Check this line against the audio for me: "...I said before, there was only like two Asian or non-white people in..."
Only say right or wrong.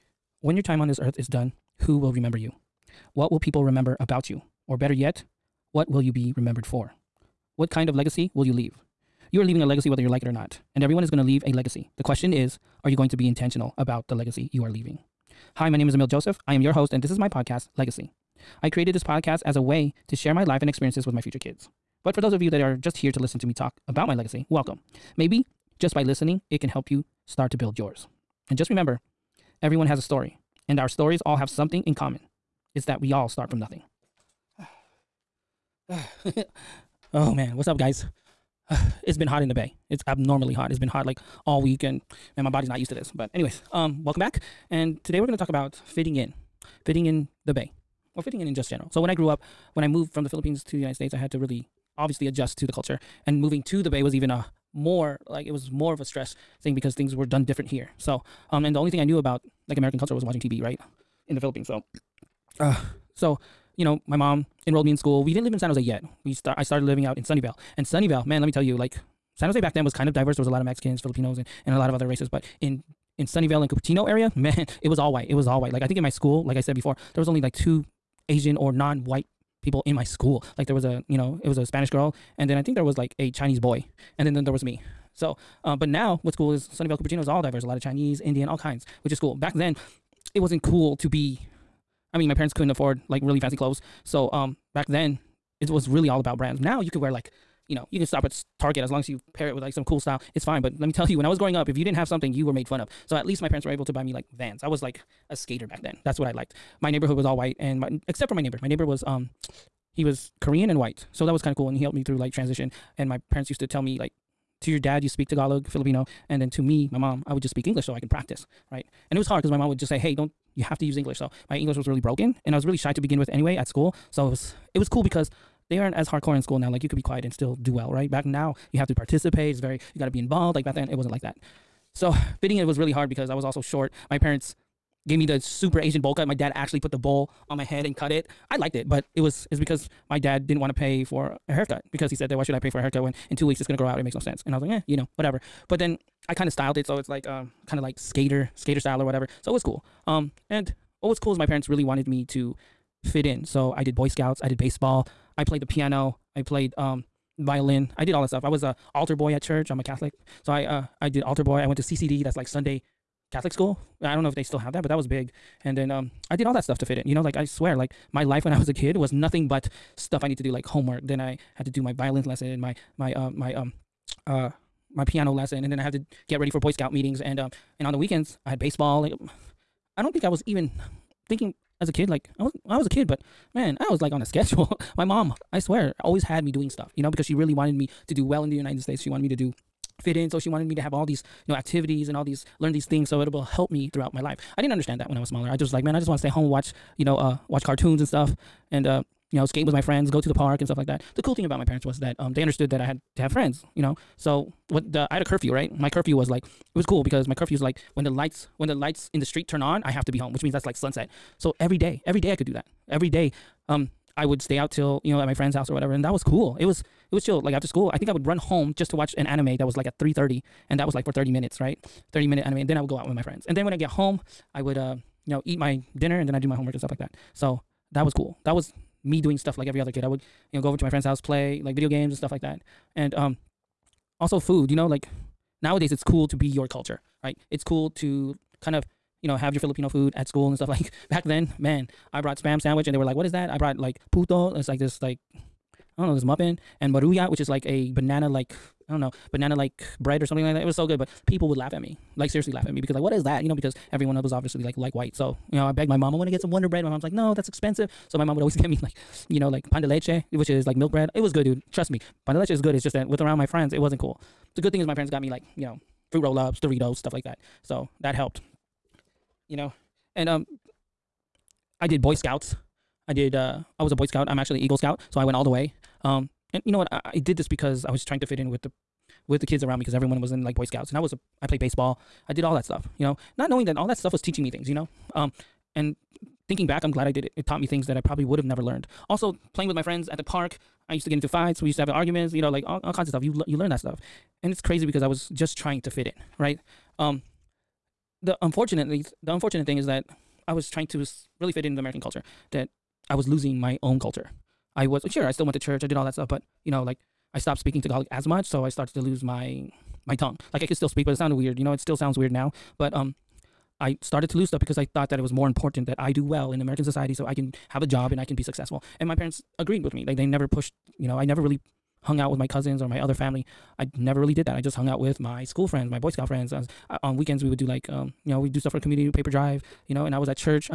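right.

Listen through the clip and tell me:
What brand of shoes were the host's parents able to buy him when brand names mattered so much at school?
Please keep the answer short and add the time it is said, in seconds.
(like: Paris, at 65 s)
Vans, at 104 s.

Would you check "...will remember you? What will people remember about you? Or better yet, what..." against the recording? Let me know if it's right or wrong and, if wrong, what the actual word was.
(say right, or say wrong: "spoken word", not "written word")
right.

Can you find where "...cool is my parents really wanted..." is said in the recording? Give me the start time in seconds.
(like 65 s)
151 s.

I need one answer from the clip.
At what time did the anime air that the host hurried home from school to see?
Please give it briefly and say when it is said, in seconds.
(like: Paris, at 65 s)
3:30, at 219 s.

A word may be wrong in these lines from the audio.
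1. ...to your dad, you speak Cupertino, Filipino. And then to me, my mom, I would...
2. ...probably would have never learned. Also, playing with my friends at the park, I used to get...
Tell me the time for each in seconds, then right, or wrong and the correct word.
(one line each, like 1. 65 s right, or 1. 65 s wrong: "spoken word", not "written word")
1. 114 s wrong: "Tagalog", not "Cupertino"
2. 287 s right.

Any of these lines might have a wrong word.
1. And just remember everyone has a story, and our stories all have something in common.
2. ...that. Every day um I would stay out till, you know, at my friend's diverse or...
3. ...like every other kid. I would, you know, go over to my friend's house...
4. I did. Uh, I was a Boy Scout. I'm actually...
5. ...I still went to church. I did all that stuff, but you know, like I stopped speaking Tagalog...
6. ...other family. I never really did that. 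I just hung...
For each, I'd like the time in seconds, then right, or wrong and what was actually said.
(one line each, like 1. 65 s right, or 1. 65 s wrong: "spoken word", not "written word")
1. 28 s right
2. 212 s wrong: "house", not "diverse"
3. 229 s right
4. 273 s right
5. 305 s right
6. 322 s right.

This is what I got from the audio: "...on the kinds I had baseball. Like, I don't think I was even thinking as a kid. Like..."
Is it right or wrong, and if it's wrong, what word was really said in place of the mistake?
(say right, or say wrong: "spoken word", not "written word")
wrong: "weekends", not "kinds".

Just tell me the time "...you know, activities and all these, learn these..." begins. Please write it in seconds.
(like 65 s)
191 s.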